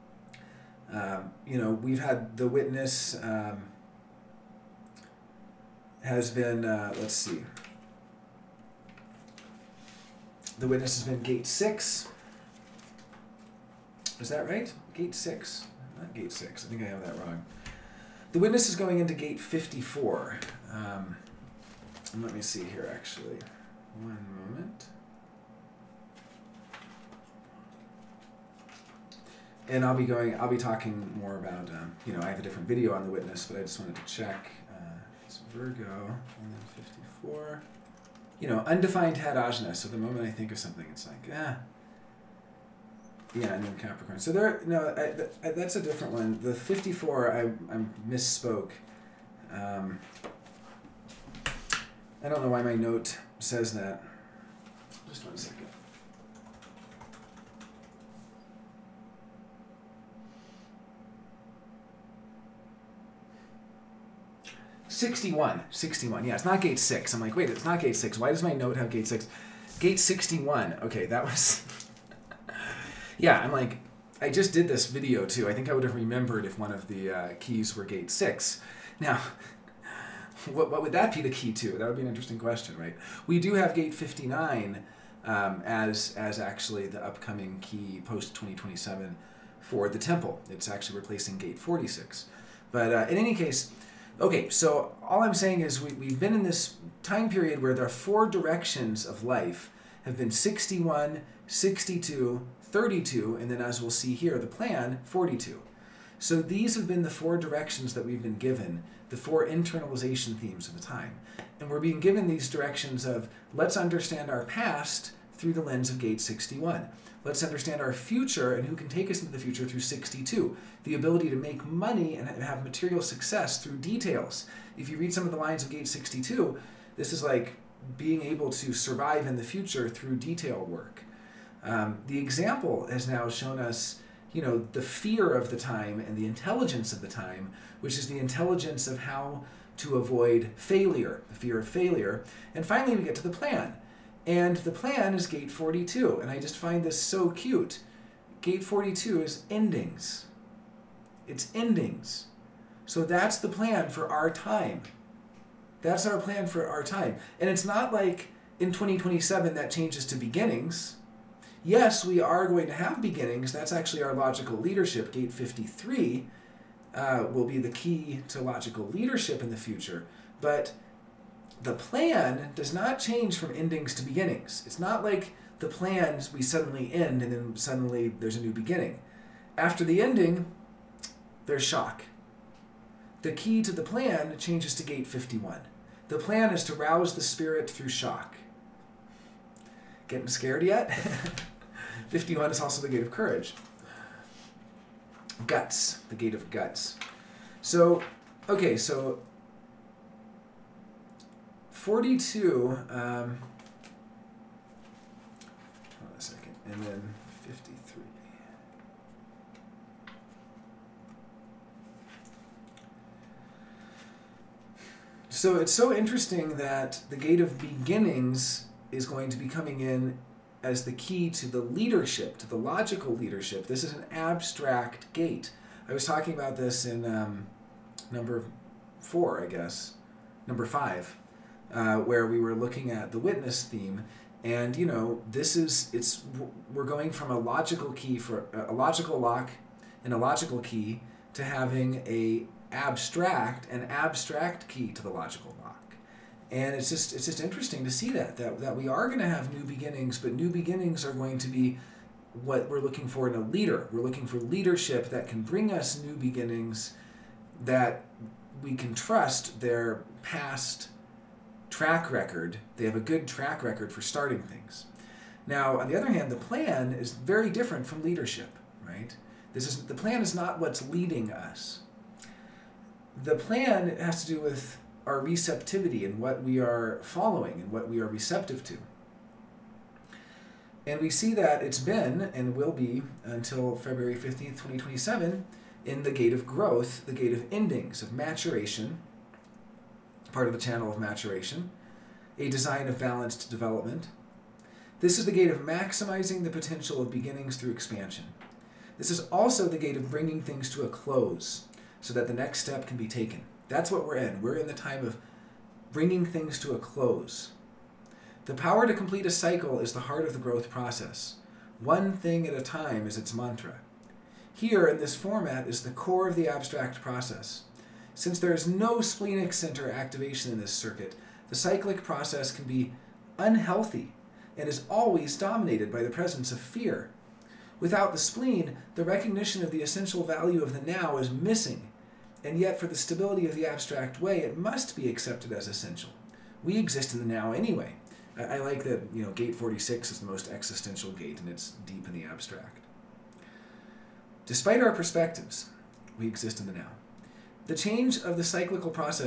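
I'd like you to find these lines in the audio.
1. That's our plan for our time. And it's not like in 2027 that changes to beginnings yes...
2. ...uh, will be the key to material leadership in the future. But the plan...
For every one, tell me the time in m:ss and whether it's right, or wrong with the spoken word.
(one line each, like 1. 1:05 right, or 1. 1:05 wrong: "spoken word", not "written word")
1. 2:35 right
2. 2:46 wrong: "logical", not "material".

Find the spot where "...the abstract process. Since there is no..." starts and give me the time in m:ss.
5:16.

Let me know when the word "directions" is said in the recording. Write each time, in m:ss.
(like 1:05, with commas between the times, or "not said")
1:38, 1:47, 1:52.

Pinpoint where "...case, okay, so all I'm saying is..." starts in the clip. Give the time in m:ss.
1:33.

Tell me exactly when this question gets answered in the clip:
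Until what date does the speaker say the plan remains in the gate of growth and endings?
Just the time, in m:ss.
4:43.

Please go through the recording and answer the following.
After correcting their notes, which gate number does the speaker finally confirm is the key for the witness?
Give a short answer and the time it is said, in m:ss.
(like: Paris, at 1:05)
61, at 1:09.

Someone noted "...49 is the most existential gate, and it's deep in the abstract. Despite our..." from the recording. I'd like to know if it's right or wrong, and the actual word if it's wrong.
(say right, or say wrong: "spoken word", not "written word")
wrong: "46", not "49".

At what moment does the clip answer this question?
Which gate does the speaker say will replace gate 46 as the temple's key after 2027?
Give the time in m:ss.
1:23.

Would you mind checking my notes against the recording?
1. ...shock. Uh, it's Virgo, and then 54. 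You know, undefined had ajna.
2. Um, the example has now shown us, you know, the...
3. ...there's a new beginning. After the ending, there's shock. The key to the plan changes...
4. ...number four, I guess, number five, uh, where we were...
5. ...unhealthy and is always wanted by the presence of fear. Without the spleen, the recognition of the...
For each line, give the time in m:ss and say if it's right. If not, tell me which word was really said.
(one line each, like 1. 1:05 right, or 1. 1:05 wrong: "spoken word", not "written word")
1. 0:34 wrong: "check", not "shock"
2. 2:11 right
3. 2:58 right
4. 3:48 right
5. 5:23 wrong: "dominated", not "wanted".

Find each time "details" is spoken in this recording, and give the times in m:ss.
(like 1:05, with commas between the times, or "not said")
2:03, 2:10.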